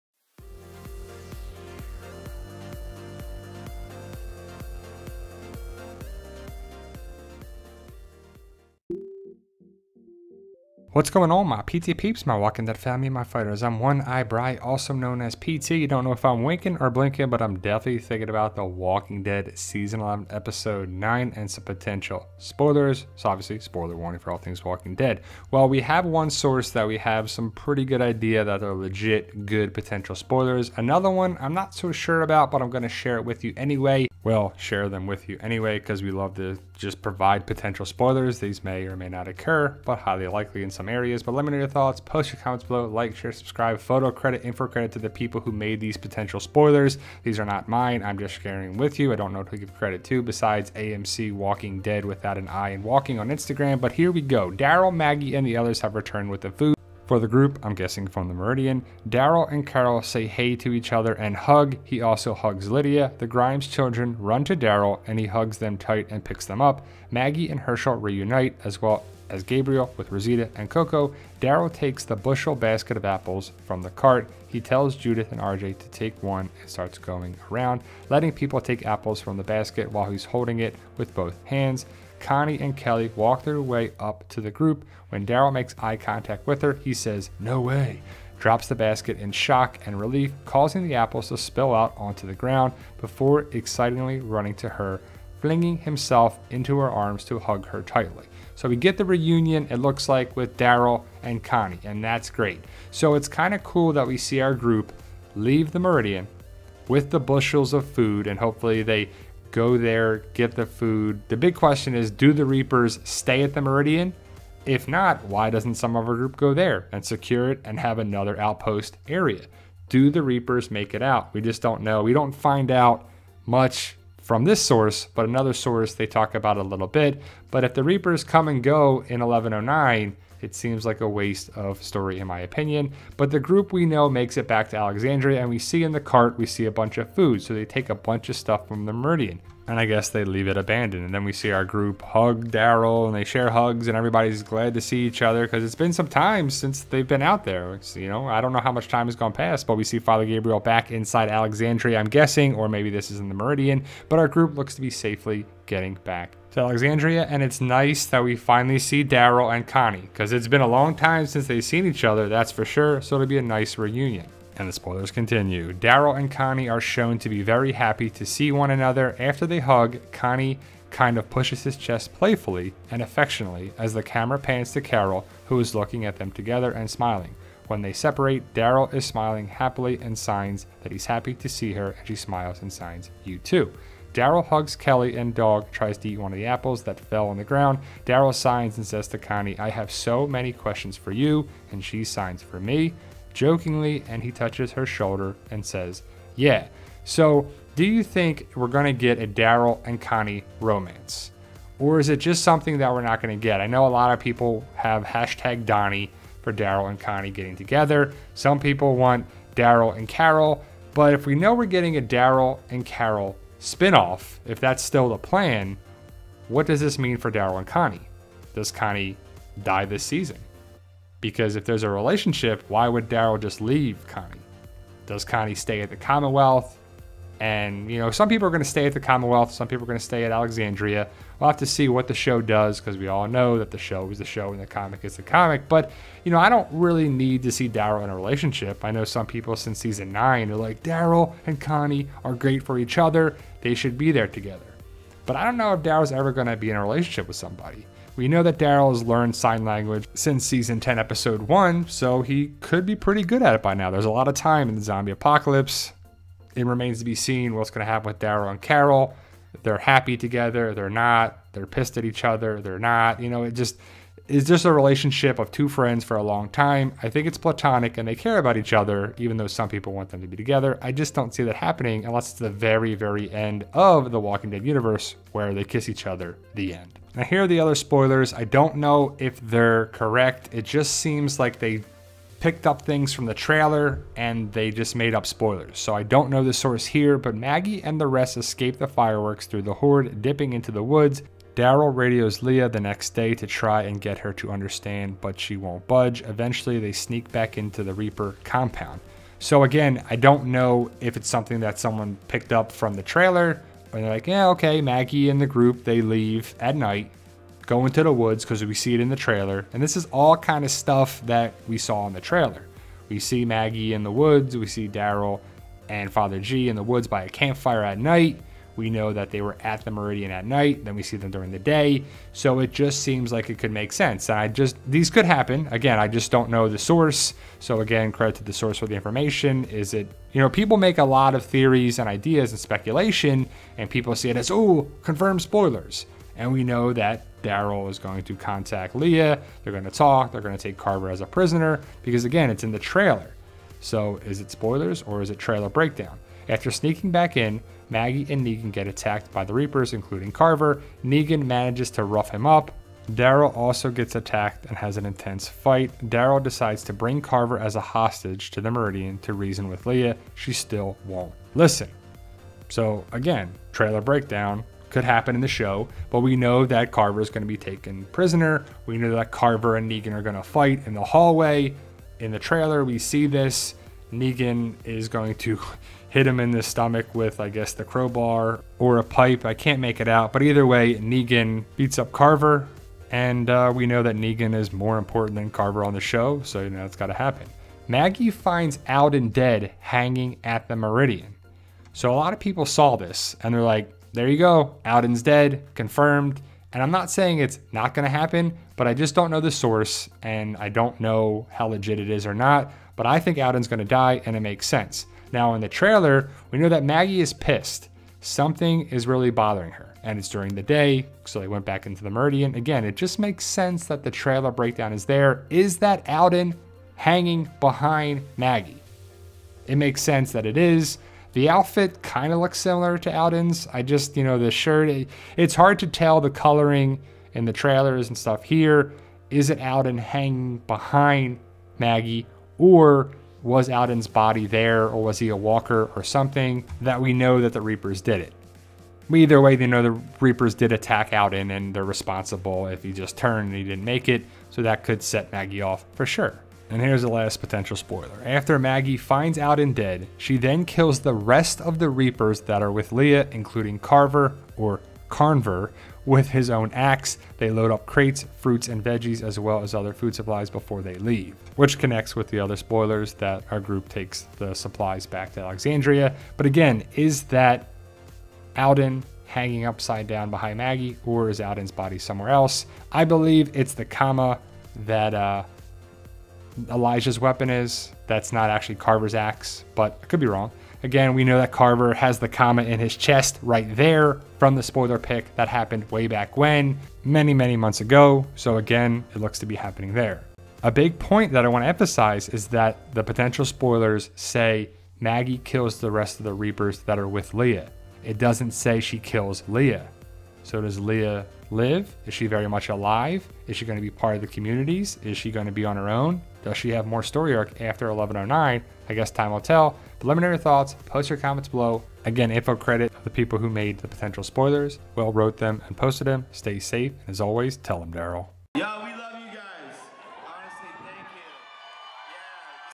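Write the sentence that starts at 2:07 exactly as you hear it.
But if the Reapers come and go in 1109, it seems like a waste of story in my opinion.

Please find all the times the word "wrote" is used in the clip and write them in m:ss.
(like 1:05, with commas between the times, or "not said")
8:35.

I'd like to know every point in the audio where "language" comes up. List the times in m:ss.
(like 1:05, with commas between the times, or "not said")
4:09.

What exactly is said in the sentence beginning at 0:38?
These may or may not occur, but highly likely in some some areas, but let me know your thoughts.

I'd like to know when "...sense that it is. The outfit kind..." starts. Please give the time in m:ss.
7:00.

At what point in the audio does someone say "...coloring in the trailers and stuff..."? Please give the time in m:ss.
7:06.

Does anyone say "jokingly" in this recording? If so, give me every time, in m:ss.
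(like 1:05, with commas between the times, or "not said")
3:13.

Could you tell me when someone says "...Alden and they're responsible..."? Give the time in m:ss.
7:21.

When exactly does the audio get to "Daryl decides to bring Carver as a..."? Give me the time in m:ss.
5:56.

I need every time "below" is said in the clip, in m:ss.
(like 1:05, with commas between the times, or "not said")
0:42, 8:31.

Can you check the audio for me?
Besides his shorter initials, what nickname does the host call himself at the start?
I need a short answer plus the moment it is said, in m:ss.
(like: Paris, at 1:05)
One Eye Bright, at 0:13.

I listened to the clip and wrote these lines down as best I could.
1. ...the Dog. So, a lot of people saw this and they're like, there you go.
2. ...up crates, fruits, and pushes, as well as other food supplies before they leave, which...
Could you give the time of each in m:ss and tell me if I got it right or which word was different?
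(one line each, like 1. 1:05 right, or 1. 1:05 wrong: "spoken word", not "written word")
1. 6:30 wrong: "Meridian", not "Dog"
2. 7:37 wrong: "veggies", not "pushes".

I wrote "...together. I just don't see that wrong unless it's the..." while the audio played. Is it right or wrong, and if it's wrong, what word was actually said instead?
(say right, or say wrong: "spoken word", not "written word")
wrong: "happening", not "wrong".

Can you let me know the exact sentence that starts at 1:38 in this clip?
So we get the reunion, it looks like, with Daryl and Connie, and that's great.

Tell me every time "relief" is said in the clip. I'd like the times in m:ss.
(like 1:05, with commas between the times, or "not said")
1:29.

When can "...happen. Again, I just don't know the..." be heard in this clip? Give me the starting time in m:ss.
5:25.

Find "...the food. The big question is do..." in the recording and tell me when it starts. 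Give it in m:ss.
1:50.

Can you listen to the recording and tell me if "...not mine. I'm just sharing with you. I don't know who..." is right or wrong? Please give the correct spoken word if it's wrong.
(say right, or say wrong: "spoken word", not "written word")
right.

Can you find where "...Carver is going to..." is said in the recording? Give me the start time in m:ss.
6:06.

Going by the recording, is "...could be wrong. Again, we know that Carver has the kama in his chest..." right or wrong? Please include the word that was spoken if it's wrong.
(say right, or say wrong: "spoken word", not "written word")
right.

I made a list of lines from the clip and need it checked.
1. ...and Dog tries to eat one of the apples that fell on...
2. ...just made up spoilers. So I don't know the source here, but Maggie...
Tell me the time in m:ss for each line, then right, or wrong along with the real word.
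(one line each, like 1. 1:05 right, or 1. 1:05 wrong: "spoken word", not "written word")
1. 3:05 right
2. 4:44 right.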